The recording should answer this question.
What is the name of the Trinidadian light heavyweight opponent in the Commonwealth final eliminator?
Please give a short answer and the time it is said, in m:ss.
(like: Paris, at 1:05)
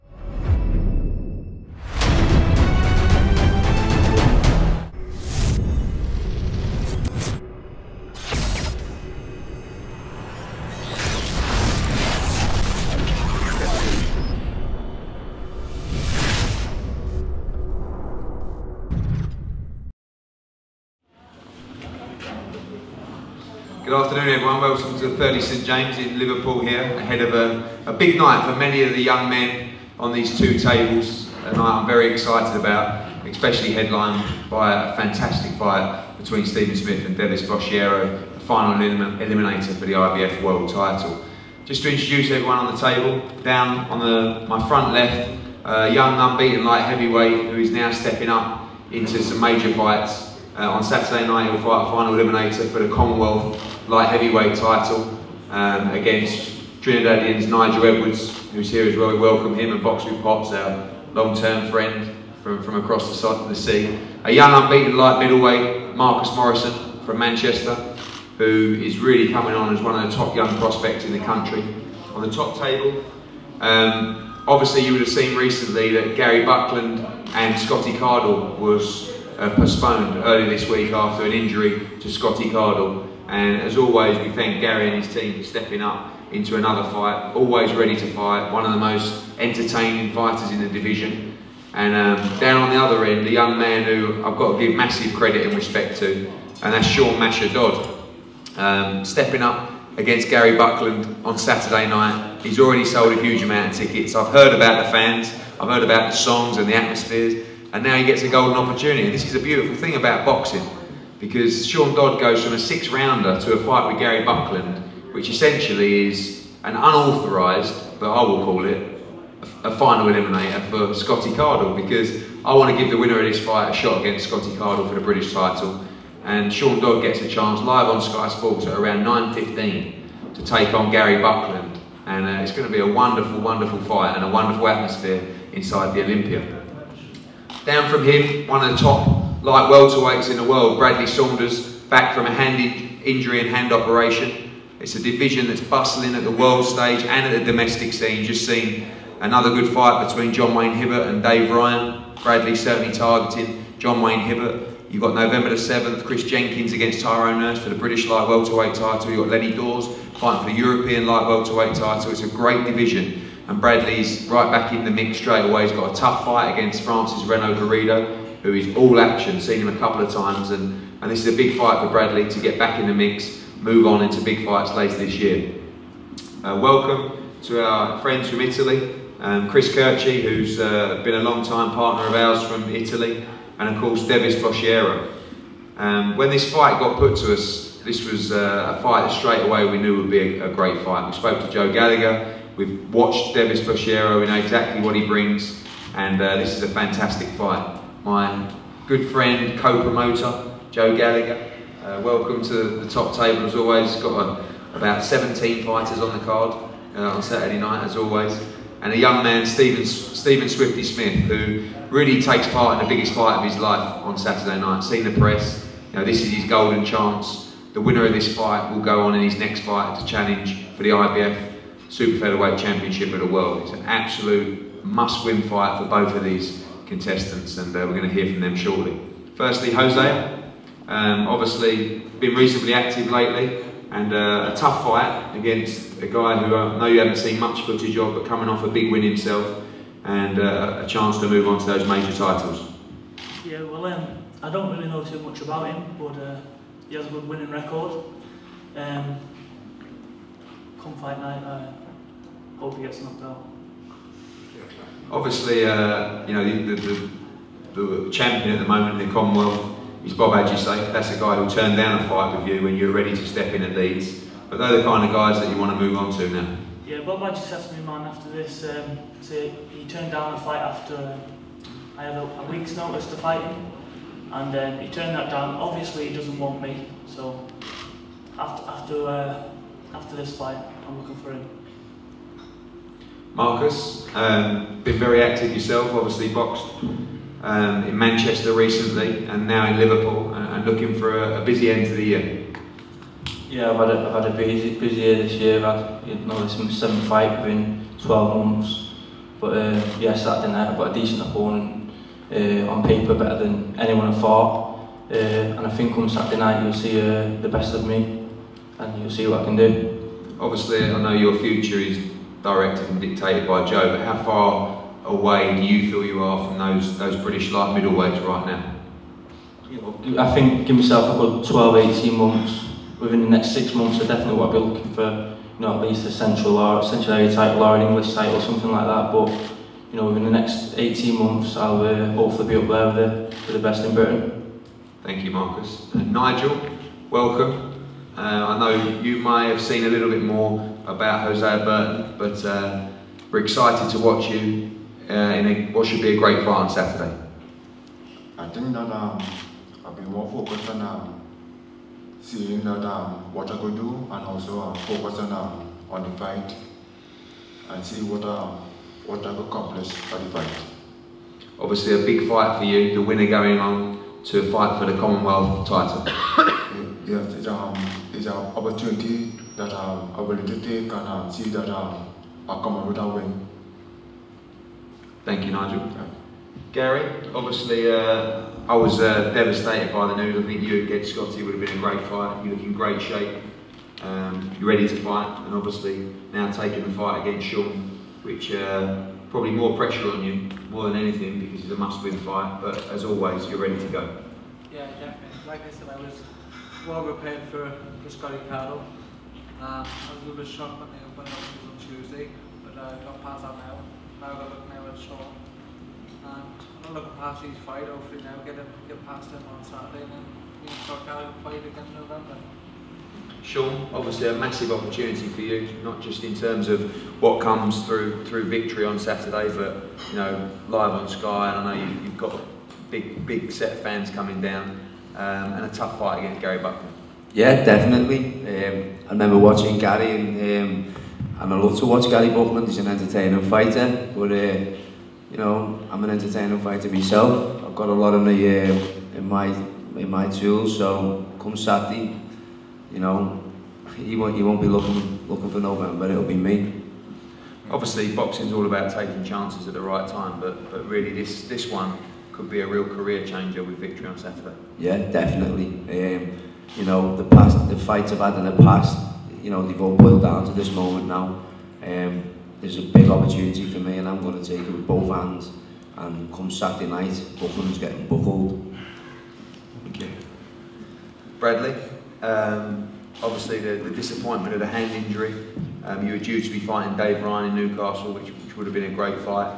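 Nigel Edwards, at 0:57.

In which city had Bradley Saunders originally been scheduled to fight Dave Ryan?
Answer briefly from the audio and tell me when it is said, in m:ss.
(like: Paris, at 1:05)
Newcastle, at 7:57.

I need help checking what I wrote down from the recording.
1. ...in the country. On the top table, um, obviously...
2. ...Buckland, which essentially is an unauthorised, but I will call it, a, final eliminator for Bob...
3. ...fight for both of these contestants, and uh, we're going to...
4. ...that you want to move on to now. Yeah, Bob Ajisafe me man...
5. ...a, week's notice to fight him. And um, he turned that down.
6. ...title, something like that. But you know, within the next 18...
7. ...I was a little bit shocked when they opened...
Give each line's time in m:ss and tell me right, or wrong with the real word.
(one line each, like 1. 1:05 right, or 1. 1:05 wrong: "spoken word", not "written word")
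1. 1:11 right
2. 1:54 wrong: "Scotty", not "Bob"
3. 3:45 right
4. 4:25 right
5. 4:32 right
6. 5:28 right
7. 6:39 right.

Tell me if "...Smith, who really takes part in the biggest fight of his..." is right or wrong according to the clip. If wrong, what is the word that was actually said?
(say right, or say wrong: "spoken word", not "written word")
right.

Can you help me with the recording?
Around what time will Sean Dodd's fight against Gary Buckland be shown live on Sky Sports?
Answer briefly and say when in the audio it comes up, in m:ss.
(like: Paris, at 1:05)
9.15, at 2:09.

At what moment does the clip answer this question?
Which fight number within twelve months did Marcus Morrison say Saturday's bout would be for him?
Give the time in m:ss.
4:56.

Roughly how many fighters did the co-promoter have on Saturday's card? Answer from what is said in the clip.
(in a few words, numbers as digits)
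17.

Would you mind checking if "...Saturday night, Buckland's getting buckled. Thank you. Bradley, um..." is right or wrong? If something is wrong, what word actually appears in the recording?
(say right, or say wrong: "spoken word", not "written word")
right.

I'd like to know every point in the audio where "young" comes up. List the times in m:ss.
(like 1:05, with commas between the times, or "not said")
0:29, 0:45, 1:04, 1:10, 1:33, 3:28.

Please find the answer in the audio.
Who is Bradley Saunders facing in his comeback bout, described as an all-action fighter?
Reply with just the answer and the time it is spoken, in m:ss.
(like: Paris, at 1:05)
Francis Renald Garrido, at 2:46.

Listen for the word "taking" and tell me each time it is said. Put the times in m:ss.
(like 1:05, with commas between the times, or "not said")
6:26, 7:28.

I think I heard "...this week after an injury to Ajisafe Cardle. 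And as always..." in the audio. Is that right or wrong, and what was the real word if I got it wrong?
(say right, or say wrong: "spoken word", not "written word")
wrong: "Scotty", not "Ajisafe".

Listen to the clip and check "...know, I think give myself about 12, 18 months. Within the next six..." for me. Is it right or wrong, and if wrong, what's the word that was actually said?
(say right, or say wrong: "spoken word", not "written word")
right.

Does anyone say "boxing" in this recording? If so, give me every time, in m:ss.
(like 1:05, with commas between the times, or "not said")
1:50, 7:28.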